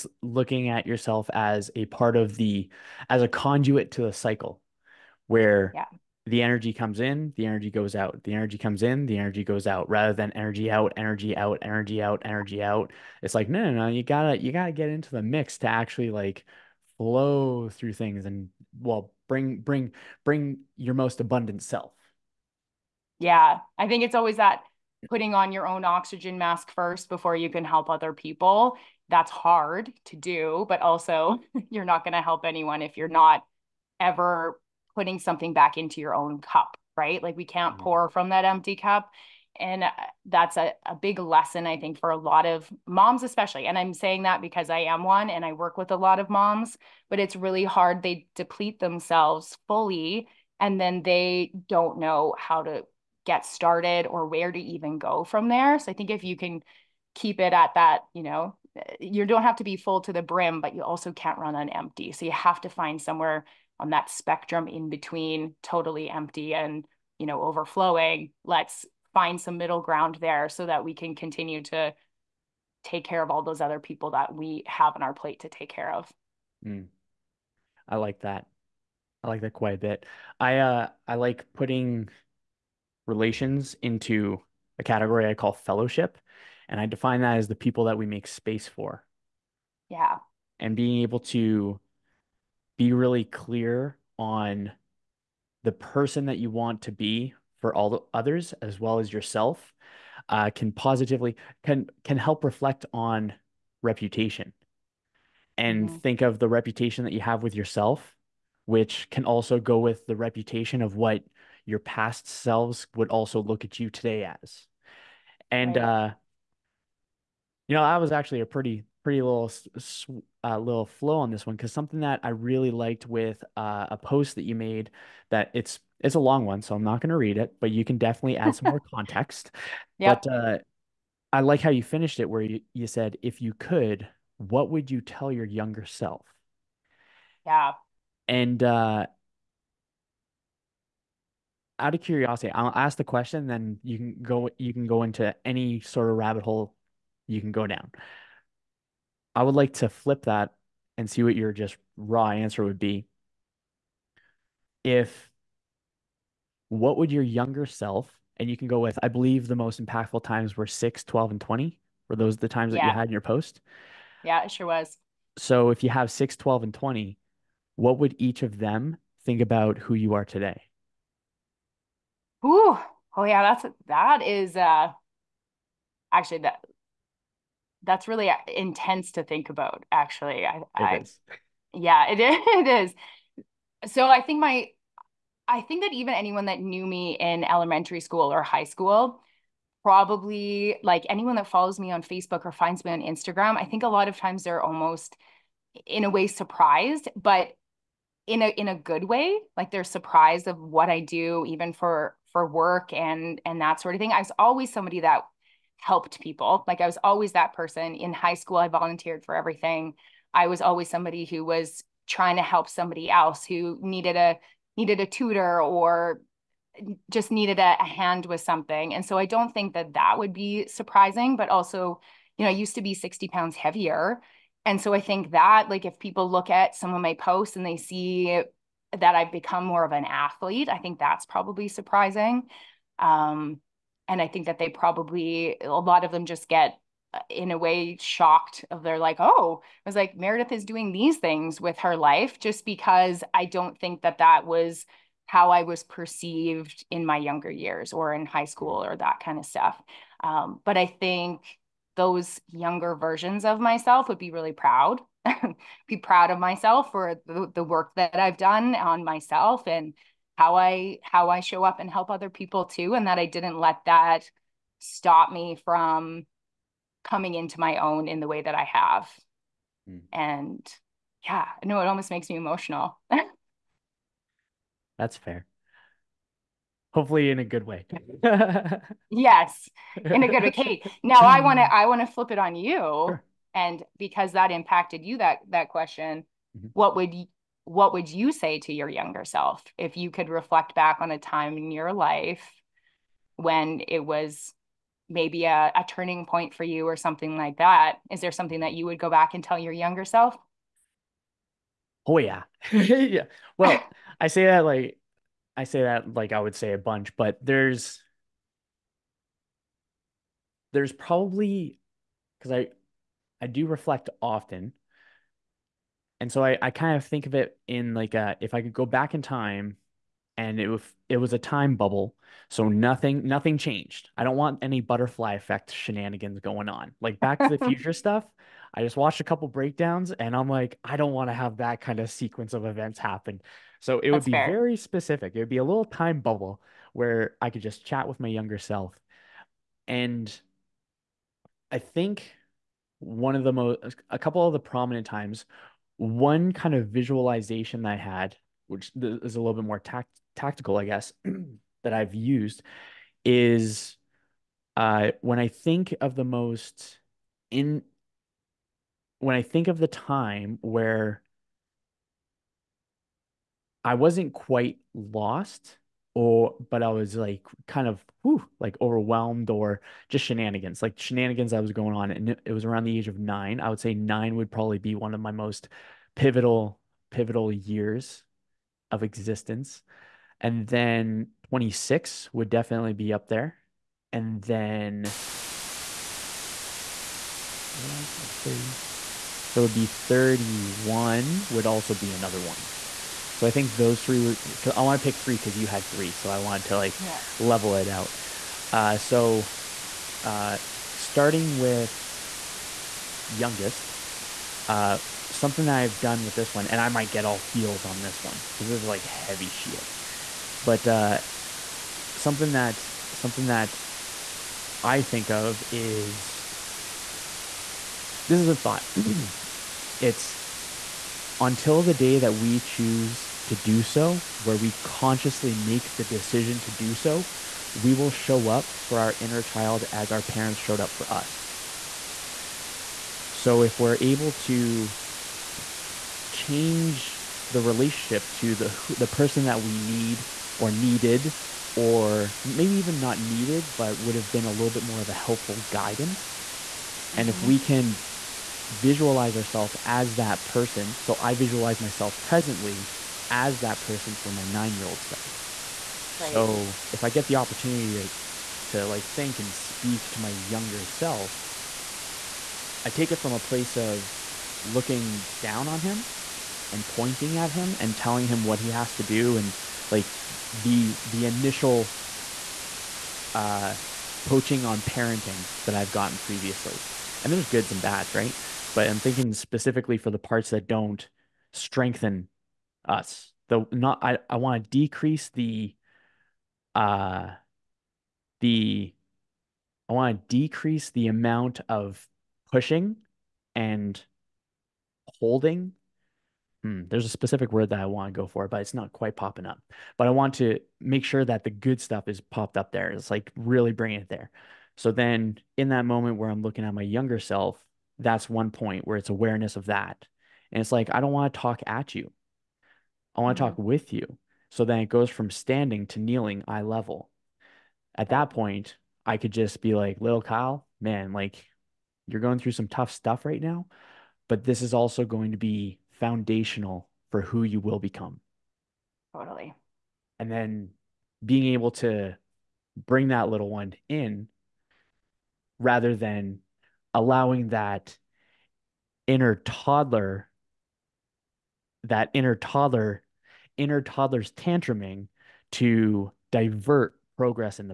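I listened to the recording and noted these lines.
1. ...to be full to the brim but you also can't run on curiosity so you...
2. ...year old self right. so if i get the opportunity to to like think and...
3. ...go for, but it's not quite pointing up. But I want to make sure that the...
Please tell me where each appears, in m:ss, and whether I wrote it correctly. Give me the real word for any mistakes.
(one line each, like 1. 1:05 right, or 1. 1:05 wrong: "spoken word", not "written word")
1. 0:59 wrong: "empty", not "curiosity"
2. 7:34 right
3. 8:18 wrong: "popping", not "pointing".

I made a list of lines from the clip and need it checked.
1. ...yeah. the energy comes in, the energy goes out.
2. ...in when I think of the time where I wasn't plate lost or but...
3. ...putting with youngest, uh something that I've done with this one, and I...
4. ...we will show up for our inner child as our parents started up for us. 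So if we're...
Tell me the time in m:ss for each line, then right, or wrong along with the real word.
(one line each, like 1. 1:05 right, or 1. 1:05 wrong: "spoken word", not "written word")
1. 0:05 right
2. 5:57 wrong: "quite", not "plate"
3. 6:40 wrong: "starting", not "putting"
4. 7:07 wrong: "showed", not "started".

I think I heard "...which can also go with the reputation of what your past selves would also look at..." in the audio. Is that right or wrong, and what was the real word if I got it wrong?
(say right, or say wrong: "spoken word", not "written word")
right.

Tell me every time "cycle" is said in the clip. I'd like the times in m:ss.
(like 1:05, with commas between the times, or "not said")
0:04.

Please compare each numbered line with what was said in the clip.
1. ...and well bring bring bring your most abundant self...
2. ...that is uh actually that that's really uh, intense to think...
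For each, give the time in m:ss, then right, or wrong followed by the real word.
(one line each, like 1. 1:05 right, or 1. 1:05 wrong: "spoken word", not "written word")
1. 0:18 right
2. 2:53 right.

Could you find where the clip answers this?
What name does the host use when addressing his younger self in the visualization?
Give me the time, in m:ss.
8:40.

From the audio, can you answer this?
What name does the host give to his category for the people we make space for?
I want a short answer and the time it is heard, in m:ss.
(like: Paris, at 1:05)
fellowship, at 1:25.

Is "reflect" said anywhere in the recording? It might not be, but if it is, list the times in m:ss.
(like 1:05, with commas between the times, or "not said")
1:42, 4:50, 5:13.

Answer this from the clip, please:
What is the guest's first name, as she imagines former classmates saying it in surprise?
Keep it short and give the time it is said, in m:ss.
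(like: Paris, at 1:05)
Meredith, at 4:00.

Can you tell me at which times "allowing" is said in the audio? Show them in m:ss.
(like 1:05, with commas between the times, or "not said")
8:56.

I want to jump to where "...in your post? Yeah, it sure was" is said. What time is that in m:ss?
2:43.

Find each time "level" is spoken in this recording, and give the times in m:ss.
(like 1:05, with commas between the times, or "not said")
6:37, 8:36.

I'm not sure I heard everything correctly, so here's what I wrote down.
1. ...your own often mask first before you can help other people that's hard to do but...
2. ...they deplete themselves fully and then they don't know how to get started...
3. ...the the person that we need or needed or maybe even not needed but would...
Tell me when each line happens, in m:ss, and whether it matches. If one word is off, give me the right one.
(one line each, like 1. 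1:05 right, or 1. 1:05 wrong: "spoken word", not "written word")
1. 0:25 wrong: "oxygen", not "often"
2. 0:48 right
3. 7:18 right.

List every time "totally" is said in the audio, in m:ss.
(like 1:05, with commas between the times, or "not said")
1:05, 8:49.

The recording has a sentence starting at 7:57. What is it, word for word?
And there's goods and bads, right?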